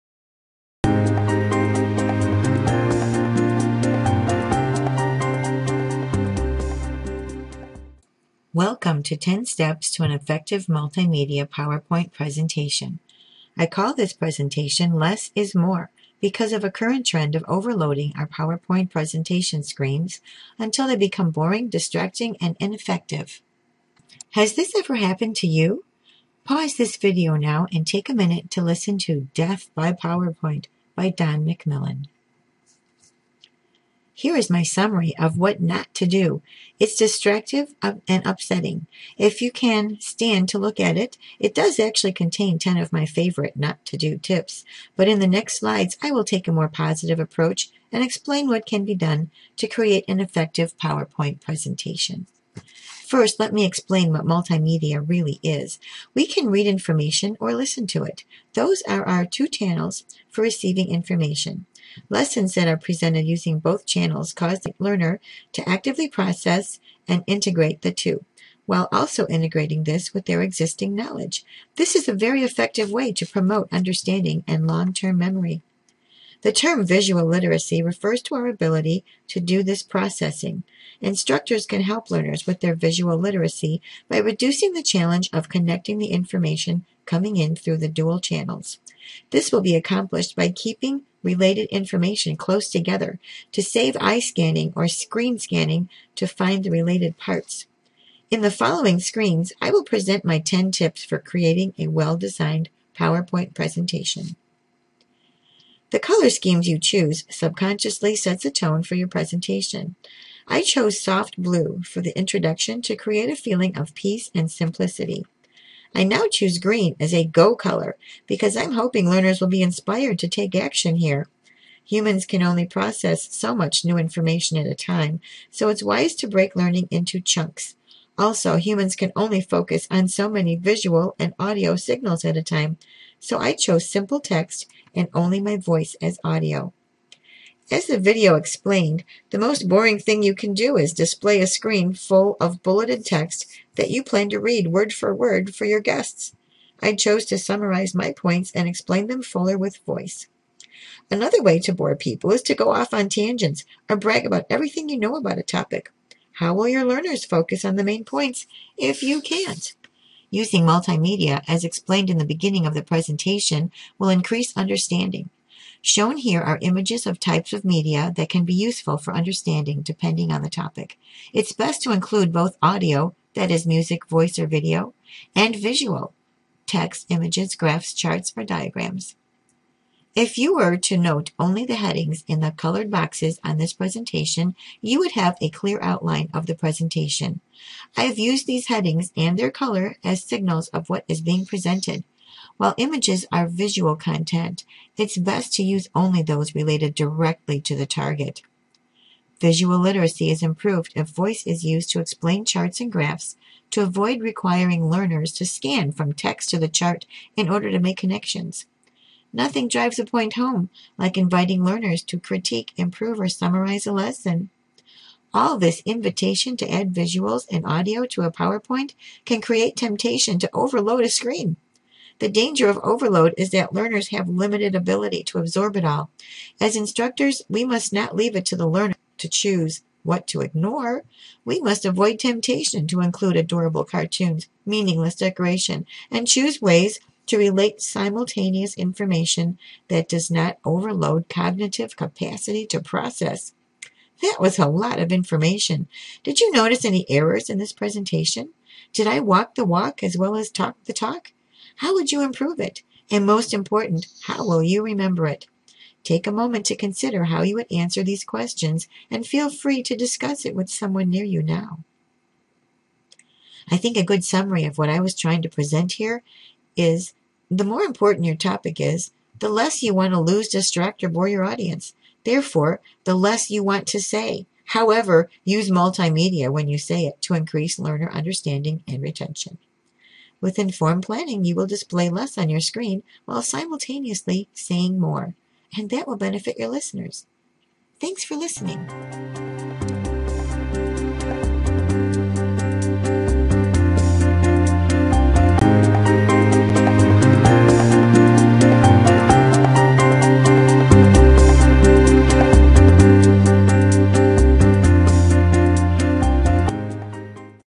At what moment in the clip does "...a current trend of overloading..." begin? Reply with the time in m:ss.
0:16.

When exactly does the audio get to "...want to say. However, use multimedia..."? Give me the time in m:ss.
4:33.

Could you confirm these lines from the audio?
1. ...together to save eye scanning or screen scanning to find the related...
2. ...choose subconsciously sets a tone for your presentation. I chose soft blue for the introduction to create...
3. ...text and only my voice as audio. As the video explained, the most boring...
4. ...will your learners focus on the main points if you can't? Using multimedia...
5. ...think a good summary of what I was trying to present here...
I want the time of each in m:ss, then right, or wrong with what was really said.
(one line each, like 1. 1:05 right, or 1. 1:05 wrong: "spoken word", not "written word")
1. 1:32 right
2. 1:46 right
3. 2:14 right
4. 2:36 right
5. 4:23 right.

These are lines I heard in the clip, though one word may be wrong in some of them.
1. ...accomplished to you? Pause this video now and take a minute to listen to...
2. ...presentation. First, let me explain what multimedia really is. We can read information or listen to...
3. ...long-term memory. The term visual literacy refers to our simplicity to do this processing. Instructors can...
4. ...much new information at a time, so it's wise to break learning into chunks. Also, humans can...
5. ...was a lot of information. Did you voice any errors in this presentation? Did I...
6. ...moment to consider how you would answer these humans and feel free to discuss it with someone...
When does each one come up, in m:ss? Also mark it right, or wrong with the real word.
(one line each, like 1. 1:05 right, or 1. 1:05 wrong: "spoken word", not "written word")
1. 0:24 wrong: "happened", not "accomplished"
2. 0:51 right
3. 1:14 wrong: "ability", not "simplicity"
4. 2:03 right
5. 4:04 wrong: "notice", not "voice"
6. 4:16 wrong: "questions", not "humans".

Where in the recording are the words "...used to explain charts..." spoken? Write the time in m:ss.
3:21.